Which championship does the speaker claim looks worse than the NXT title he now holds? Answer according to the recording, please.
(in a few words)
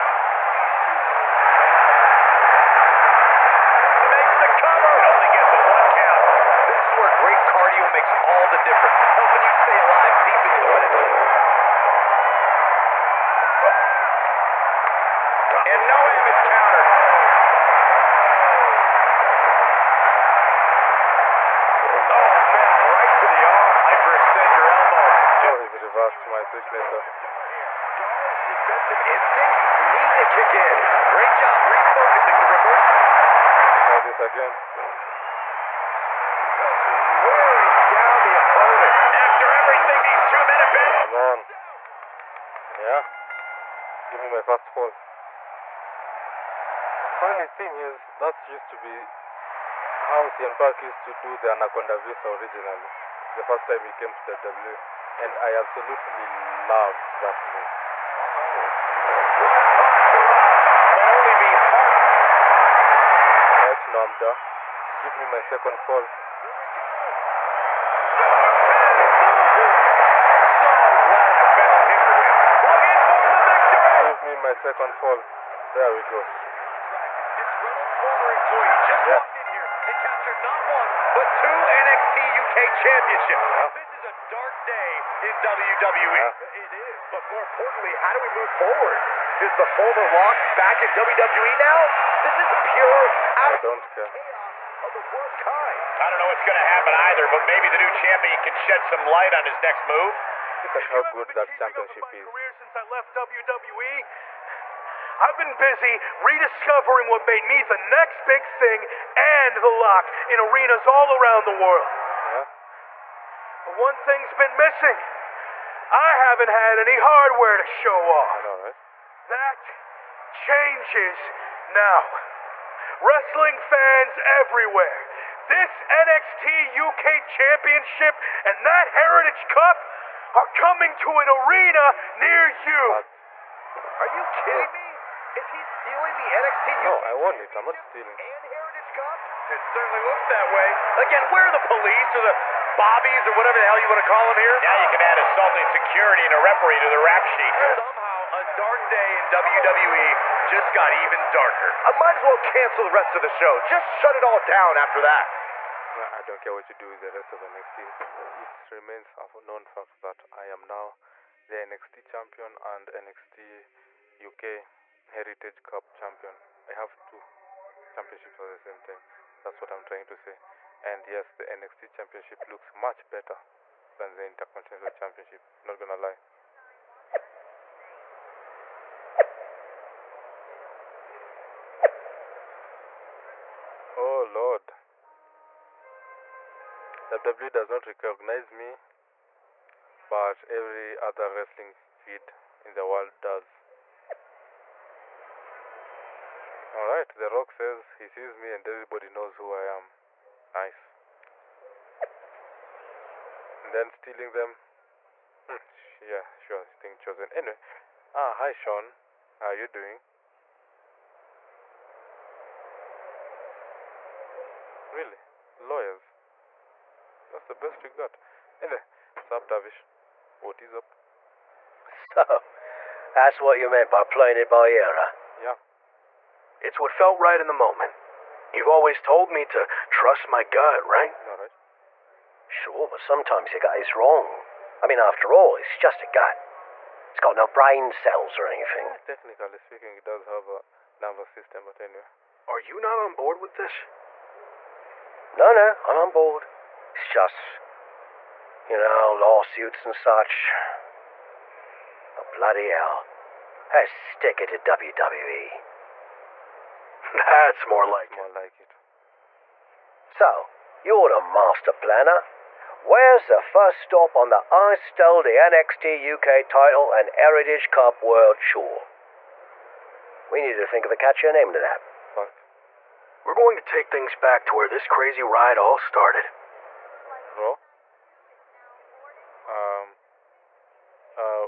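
Intercontinental Championship.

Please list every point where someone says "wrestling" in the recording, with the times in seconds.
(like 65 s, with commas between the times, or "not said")
122 s, 191 s.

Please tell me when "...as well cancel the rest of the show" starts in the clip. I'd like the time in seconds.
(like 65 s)
152 s.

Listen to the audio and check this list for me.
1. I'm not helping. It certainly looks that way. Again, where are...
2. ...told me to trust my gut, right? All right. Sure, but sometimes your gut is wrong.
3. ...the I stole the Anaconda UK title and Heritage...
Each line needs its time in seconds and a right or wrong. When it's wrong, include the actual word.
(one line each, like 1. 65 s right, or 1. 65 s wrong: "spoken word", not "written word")
1. 137 s wrong: "stealing", not "helping"
2. 229 s right
3. 264 s wrong: "NXT", not "Anaconda".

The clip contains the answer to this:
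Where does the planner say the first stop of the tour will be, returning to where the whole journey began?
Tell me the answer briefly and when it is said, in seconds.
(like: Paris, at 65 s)
Raw, at 277 s.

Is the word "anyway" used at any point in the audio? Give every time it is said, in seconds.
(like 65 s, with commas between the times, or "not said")
207 s, 218 s, 241 s.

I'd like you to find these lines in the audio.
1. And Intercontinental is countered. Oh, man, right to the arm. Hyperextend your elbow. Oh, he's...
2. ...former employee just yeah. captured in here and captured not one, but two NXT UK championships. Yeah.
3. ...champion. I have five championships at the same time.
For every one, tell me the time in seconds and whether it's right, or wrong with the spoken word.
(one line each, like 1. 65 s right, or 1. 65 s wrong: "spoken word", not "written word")
1. 15 s wrong: "Noam", not "Intercontinental"
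2. 77 s wrong: "walked", not "captured"
3. 165 s wrong: "two", not "five".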